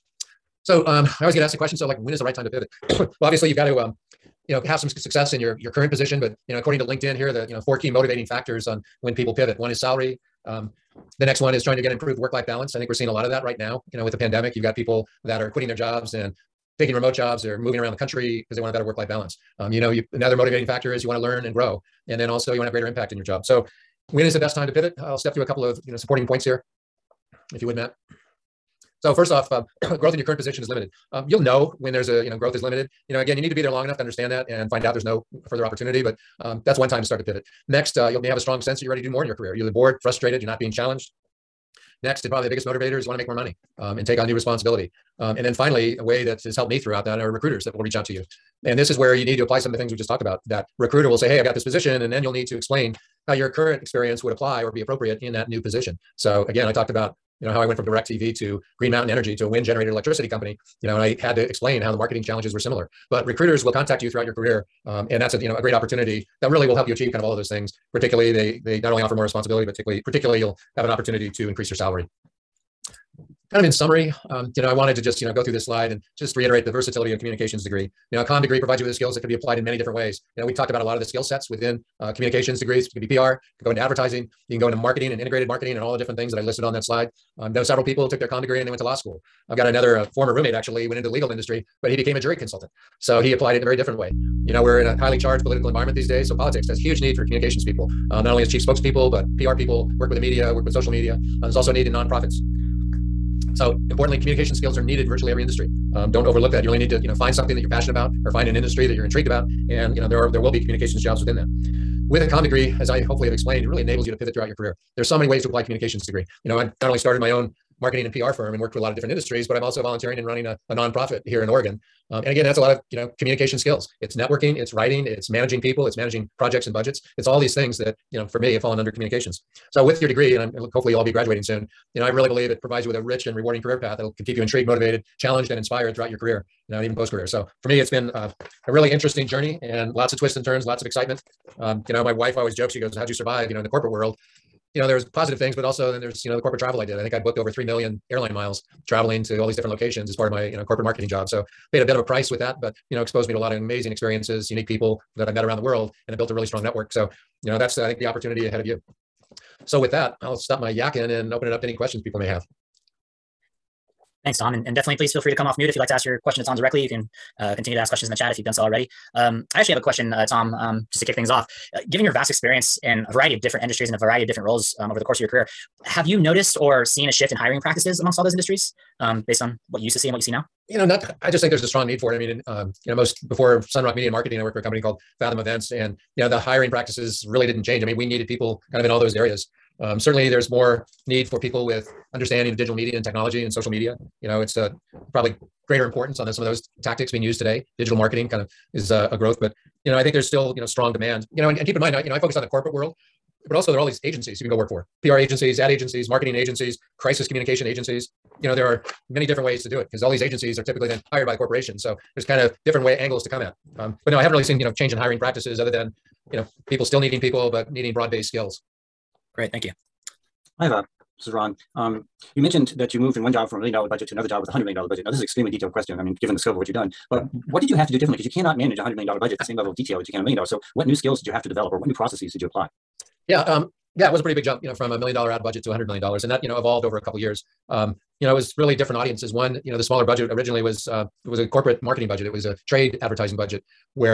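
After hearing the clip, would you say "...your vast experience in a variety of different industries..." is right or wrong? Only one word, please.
right.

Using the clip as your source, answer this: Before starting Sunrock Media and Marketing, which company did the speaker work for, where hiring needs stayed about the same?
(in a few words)
Fathom Events.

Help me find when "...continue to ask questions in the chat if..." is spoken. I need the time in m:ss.
2:47.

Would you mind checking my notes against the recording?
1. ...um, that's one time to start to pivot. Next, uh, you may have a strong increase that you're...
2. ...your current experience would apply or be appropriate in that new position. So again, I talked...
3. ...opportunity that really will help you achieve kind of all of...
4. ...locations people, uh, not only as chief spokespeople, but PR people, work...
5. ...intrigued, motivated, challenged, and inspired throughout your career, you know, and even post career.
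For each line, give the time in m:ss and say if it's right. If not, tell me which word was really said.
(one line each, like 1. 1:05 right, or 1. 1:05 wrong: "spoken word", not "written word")
1. 0:36 wrong: "sense", not "increase"
2. 0:53 right
3. 1:05 right
4. 1:37 wrong: "communications", not "locations"
5. 2:14 right.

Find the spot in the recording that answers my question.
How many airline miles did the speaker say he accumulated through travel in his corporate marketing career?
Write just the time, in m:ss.
2:27.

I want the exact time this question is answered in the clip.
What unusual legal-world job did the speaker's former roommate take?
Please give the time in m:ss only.
1:32.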